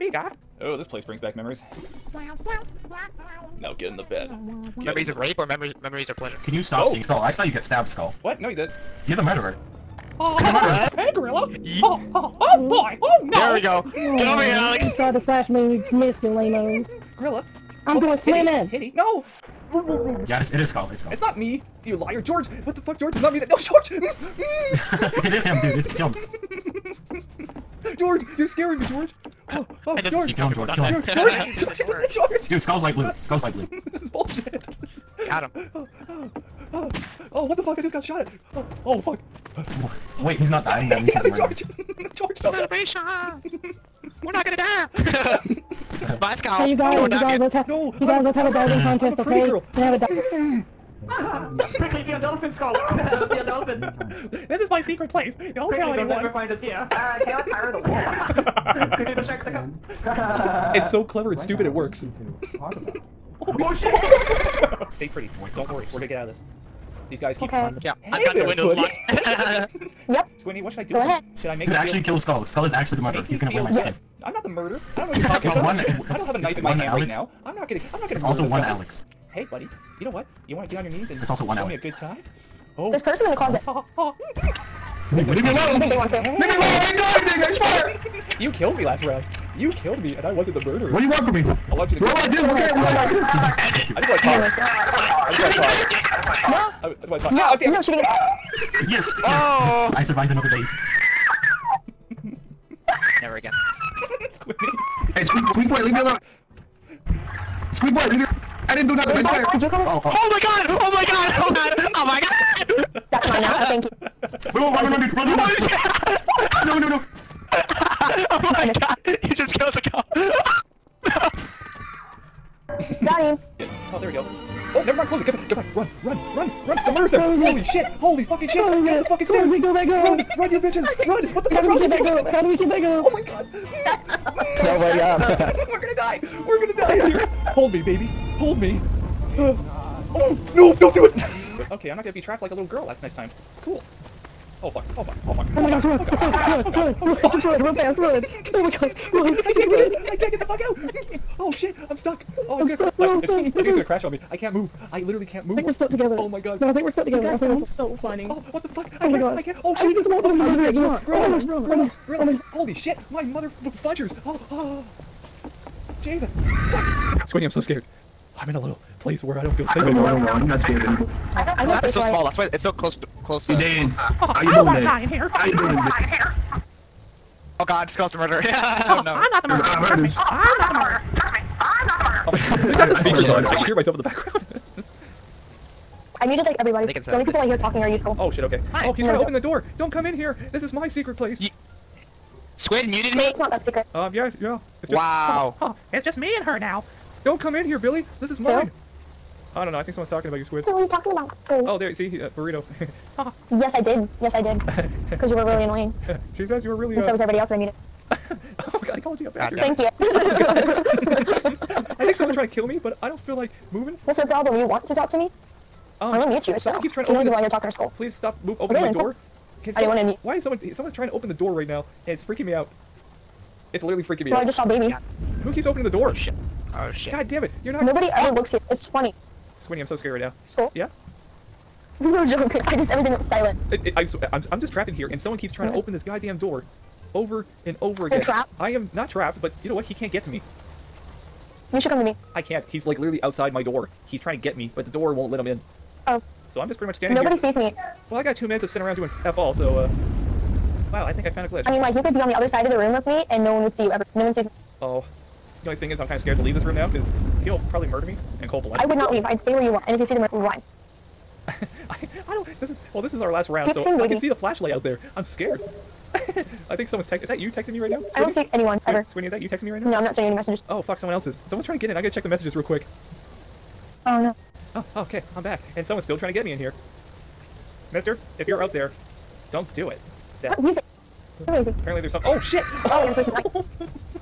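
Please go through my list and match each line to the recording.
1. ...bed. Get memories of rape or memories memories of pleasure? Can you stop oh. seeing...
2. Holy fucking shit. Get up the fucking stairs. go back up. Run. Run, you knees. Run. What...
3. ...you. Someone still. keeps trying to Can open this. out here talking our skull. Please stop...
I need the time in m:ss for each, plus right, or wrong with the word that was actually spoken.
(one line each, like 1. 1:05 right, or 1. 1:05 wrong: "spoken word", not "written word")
1. 0:04 right
2. 2:07 wrong: "bitches", not "knees"
3. 3:36 right.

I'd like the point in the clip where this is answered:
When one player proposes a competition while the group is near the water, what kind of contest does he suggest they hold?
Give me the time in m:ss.
0:48.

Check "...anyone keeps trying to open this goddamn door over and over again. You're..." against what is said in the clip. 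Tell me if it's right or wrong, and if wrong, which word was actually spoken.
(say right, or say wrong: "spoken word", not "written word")
wrong: "someone", not "anyone".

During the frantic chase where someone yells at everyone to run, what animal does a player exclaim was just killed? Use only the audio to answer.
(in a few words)
cow.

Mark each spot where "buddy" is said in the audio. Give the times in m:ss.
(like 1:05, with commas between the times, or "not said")
1:08, 1:19.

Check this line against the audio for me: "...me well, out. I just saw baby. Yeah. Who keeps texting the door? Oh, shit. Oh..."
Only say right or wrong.
wrong.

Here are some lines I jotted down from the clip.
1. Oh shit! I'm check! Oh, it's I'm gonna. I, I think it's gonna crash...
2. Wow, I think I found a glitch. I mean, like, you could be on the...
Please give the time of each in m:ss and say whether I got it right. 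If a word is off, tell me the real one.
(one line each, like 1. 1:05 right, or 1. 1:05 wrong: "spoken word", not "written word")
1. 2:31 wrong: "stuck", not "check"
2. 4:10 right.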